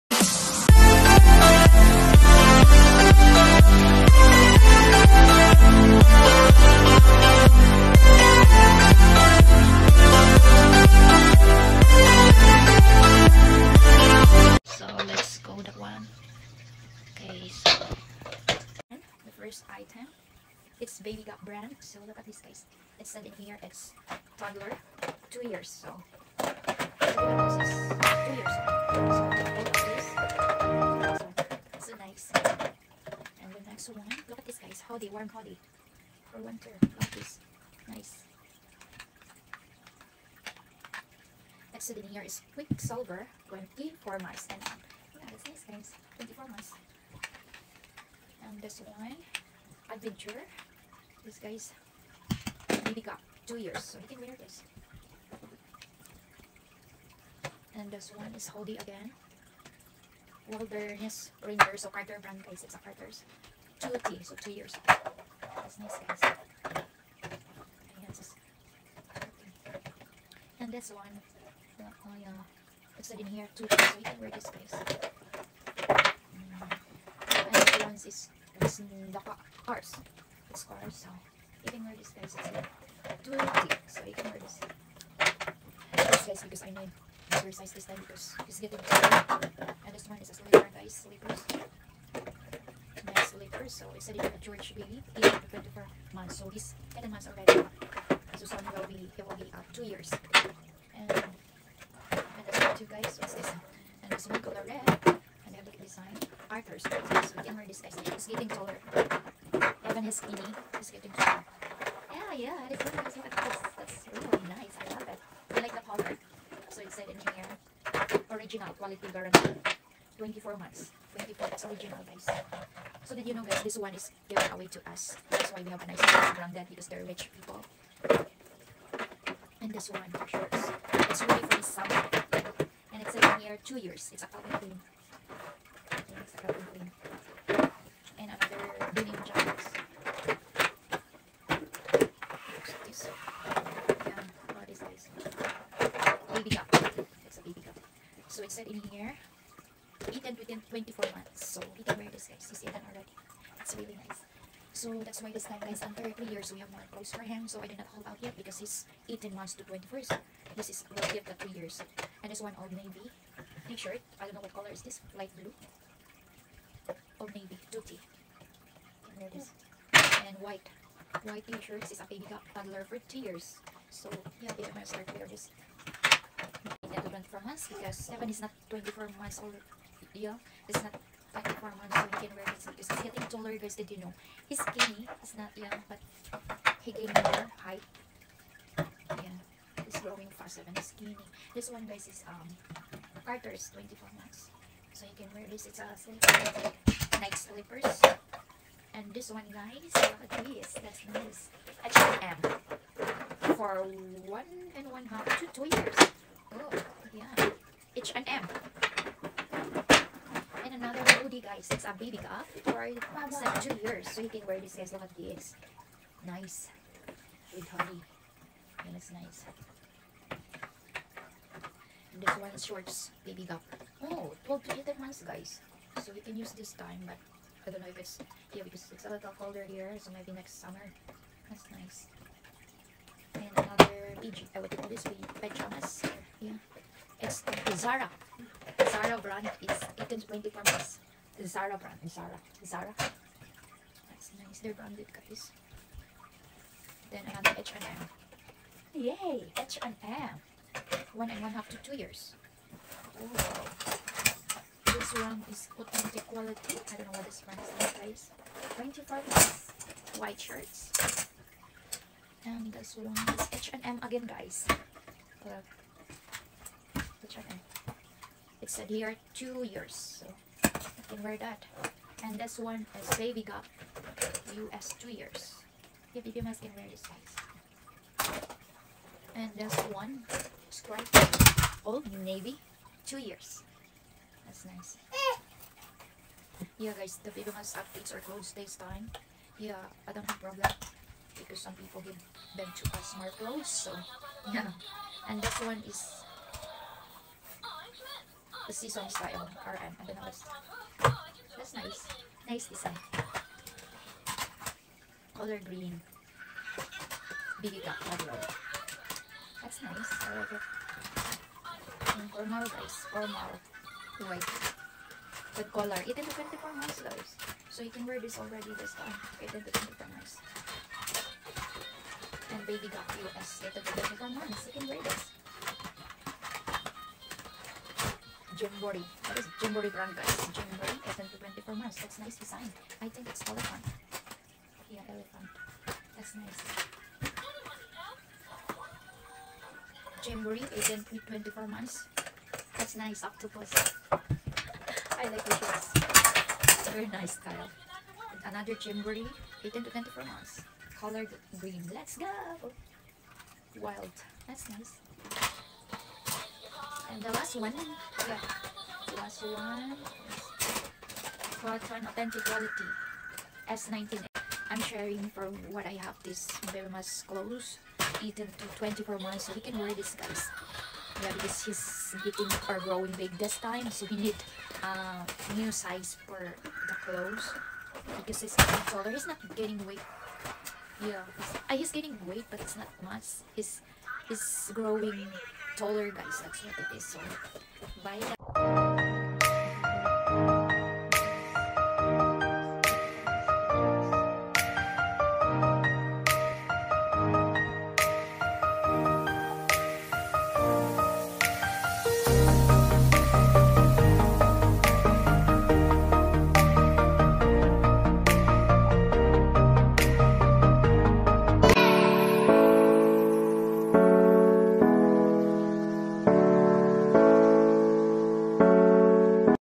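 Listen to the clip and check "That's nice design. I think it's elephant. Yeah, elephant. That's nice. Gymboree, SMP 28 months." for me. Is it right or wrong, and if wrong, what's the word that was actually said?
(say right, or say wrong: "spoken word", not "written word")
wrong: "24", not "28".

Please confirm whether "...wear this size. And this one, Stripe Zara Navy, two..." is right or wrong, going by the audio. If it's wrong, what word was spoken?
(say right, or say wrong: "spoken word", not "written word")
wrong: "Old", not "Zara".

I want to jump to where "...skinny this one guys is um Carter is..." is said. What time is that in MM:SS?
03:10.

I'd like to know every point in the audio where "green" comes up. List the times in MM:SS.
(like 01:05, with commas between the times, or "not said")
05:05, 05:51.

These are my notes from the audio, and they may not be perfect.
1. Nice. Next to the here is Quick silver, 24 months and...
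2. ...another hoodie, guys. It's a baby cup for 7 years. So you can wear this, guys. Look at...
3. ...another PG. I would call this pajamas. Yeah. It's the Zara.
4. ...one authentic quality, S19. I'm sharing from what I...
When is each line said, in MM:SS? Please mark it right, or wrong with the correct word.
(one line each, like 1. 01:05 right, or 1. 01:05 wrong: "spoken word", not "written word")
1. 00:37 right
2. 03:30 right
3. 03:53 right
4. 05:59 right.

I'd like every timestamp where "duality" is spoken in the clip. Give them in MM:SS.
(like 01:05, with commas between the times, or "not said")
01:23.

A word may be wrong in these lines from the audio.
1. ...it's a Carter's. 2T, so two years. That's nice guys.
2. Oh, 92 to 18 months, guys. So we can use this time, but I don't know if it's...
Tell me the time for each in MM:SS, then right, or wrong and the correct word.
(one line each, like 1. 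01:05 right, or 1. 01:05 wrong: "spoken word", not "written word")
1. 01:02 right
2. 03:44 wrong: "12", not "92".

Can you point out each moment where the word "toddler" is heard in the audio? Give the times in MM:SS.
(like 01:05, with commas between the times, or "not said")
00:24, 02:52.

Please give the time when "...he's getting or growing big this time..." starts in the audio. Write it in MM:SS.
06:11.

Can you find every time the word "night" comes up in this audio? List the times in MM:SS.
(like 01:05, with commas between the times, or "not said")
03:17.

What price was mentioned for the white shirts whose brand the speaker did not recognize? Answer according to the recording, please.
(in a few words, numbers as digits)
$25.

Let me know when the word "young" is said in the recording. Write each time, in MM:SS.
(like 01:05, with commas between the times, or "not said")
03:05.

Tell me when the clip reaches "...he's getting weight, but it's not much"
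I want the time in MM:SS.
06:21.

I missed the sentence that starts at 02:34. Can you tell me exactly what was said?
So that's why this time guys, under 3 years, we have more clothes for him.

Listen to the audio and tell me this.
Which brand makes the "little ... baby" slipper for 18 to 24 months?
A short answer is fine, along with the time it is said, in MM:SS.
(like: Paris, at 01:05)
George, at 01:34.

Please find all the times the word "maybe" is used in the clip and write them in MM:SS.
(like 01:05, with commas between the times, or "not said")
00:52, 03:50.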